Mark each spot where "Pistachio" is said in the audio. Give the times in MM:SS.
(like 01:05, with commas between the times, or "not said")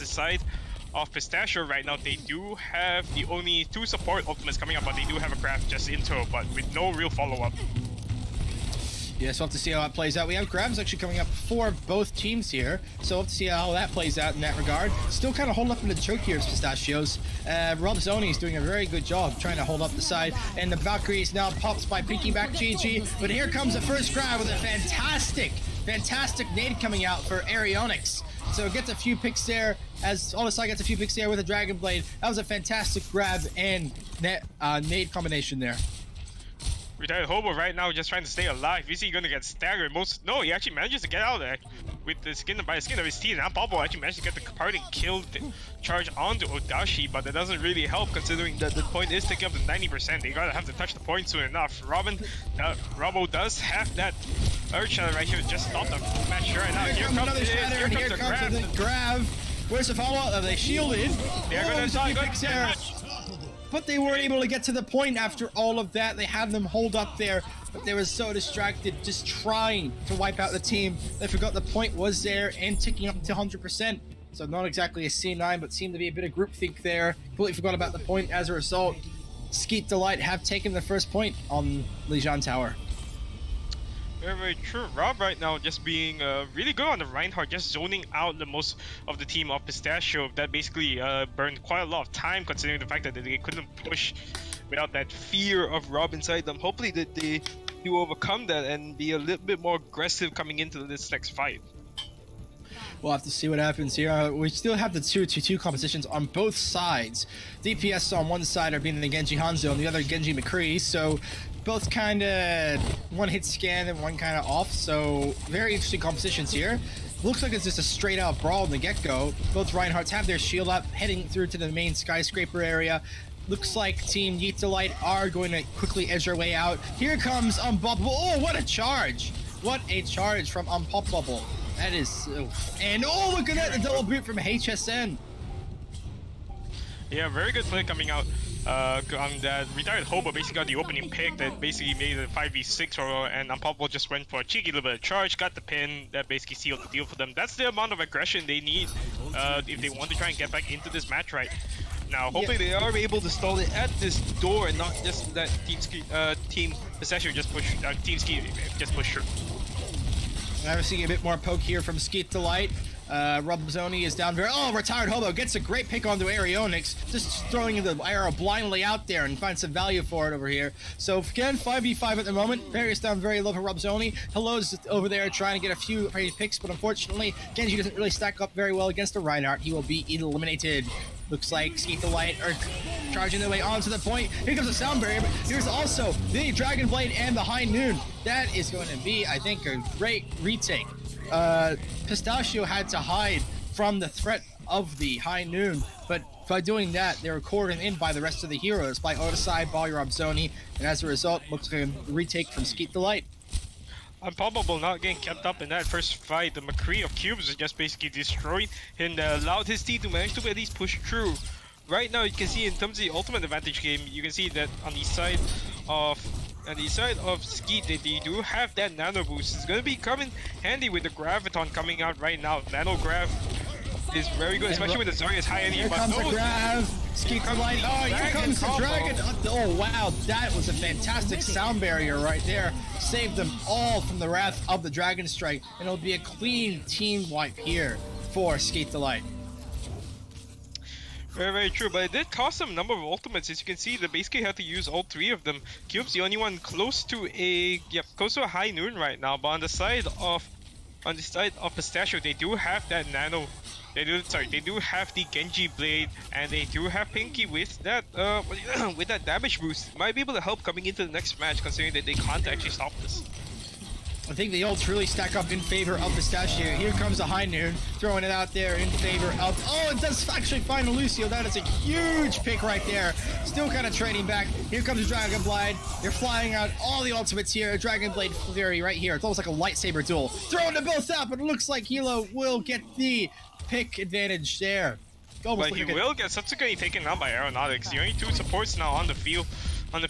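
00:01, 00:16, 01:29, 02:36, 03:12, 04:11, 04:26.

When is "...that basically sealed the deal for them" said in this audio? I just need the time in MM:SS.
02:26.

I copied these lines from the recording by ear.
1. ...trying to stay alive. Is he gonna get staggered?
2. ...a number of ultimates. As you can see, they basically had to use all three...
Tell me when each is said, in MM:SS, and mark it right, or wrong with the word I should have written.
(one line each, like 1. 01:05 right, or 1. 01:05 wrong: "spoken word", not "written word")
1. 00:38 right
2. 04:02 right.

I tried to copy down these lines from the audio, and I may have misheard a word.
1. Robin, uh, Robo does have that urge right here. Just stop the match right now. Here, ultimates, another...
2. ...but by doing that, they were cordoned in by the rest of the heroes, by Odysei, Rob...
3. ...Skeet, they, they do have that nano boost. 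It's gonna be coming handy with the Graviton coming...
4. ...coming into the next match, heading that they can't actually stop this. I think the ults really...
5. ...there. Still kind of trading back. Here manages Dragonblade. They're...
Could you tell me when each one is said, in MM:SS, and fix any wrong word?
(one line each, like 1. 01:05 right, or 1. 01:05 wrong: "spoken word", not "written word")
1. 00:51 wrong: "comes", not "ultimates"
2. 03:16 wrong: "Balrog", not "Rob"
3. 03:37 right
4. 04:20 wrong: "considering", not "heading"
5. 04:32 wrong: "comes", not "manages".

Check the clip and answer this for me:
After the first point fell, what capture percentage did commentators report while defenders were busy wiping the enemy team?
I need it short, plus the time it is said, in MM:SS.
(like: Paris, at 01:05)
100%, at 01:13.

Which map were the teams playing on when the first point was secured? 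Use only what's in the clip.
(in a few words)
Lijiang Tower.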